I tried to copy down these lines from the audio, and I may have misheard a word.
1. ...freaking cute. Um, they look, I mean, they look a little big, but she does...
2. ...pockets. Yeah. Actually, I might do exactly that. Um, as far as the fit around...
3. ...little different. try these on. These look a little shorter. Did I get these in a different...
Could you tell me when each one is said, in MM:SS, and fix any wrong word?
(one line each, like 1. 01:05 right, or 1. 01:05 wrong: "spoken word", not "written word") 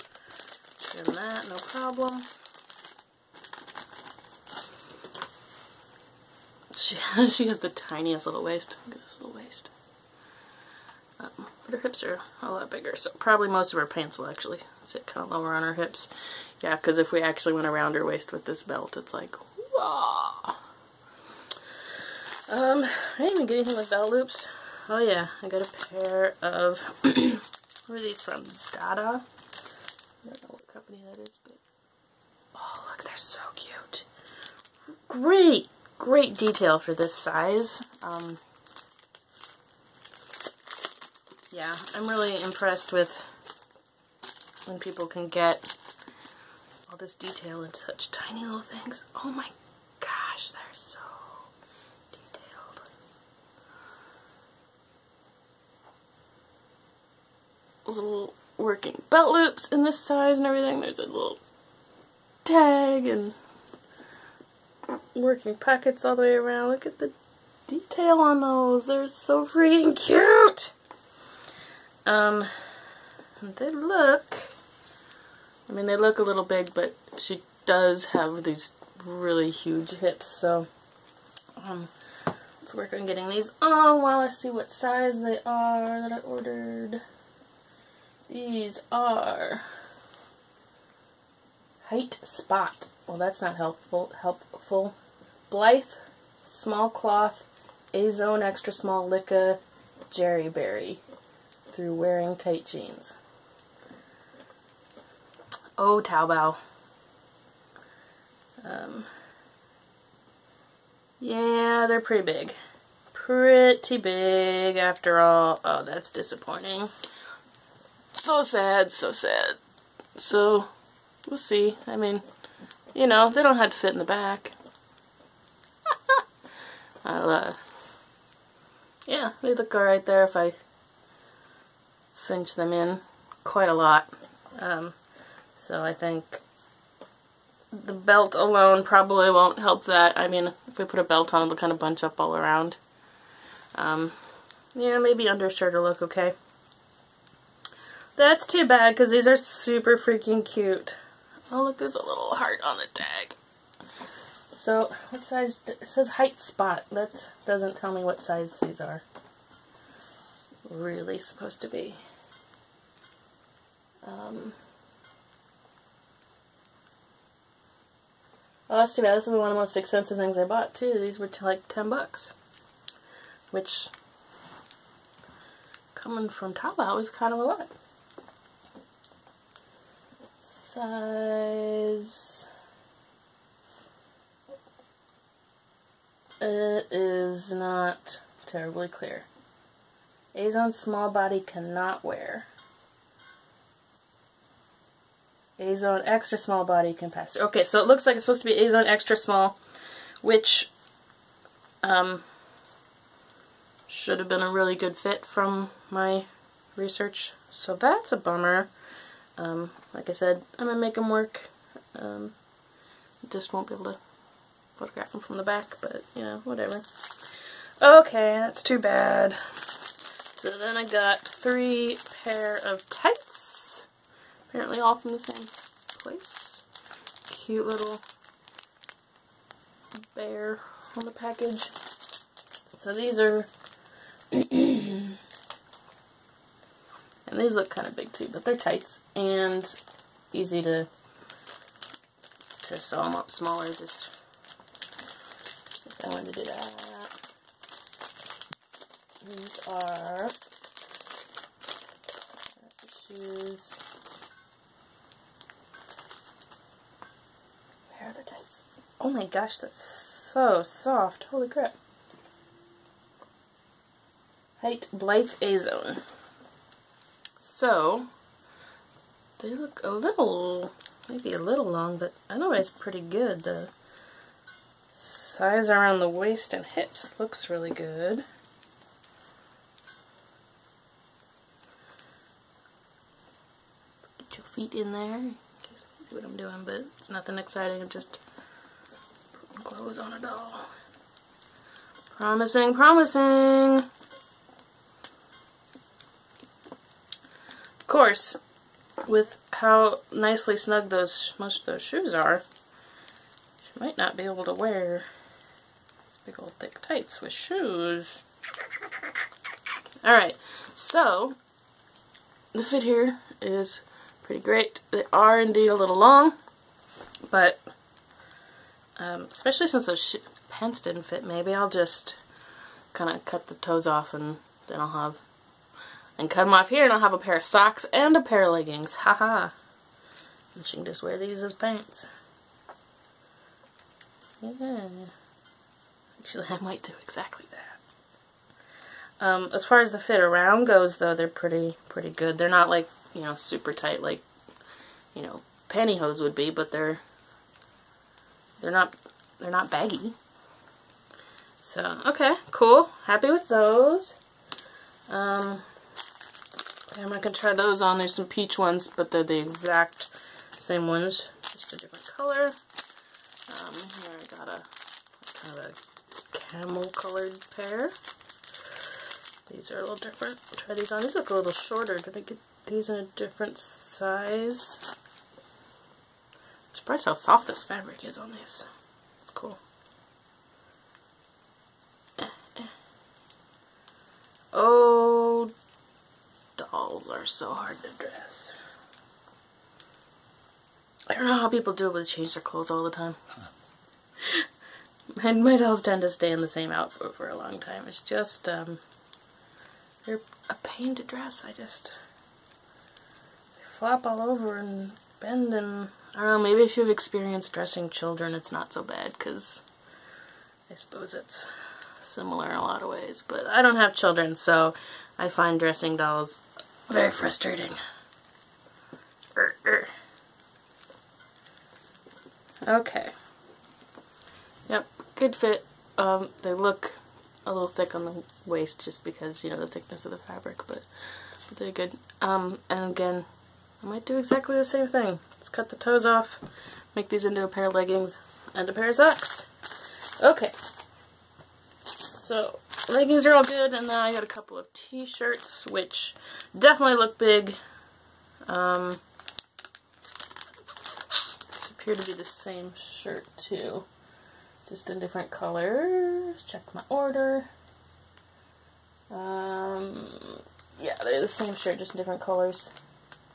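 1. 01:09 right
2. 05:31 wrong: "pants", not "pockets"
3. 06:09 right.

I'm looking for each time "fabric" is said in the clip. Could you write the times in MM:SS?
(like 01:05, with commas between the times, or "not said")
06:17, 07:10.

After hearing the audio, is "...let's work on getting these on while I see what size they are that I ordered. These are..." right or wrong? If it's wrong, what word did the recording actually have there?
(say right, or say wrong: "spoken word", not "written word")
right.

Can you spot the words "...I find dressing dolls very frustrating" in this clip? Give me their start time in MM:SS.
06:55.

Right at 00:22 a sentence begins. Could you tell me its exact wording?
Um, I didn't even get anything with belt loops.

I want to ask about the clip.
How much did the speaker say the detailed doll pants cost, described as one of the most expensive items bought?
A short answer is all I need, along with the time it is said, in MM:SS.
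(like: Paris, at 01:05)
10 bucks, at 02:51.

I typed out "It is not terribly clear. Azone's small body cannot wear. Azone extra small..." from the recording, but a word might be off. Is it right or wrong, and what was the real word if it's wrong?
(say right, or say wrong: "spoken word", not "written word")
right.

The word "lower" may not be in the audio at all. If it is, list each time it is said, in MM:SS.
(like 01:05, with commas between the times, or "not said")
00:15.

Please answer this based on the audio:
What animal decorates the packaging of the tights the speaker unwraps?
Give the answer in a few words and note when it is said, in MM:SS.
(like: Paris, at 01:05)
Bear, at 03:50.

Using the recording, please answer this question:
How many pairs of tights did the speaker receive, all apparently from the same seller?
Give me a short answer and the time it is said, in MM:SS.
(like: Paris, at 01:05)
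3, at 03:41.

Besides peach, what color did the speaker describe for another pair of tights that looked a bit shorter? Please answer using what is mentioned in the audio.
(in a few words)
Camel.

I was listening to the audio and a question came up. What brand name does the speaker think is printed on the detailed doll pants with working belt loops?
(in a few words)
Dada.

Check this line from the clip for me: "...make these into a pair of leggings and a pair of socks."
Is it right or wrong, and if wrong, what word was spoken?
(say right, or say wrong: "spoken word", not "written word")
right.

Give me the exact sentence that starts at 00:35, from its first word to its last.
Great, great detail for this size.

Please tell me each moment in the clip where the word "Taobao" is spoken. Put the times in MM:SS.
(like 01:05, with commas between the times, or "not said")
01:46, 02:56.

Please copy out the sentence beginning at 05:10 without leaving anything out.
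Alright, so the fit here is pretty great.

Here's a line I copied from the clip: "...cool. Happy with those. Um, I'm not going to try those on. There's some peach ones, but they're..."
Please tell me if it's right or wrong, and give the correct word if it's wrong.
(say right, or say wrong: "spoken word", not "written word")
right.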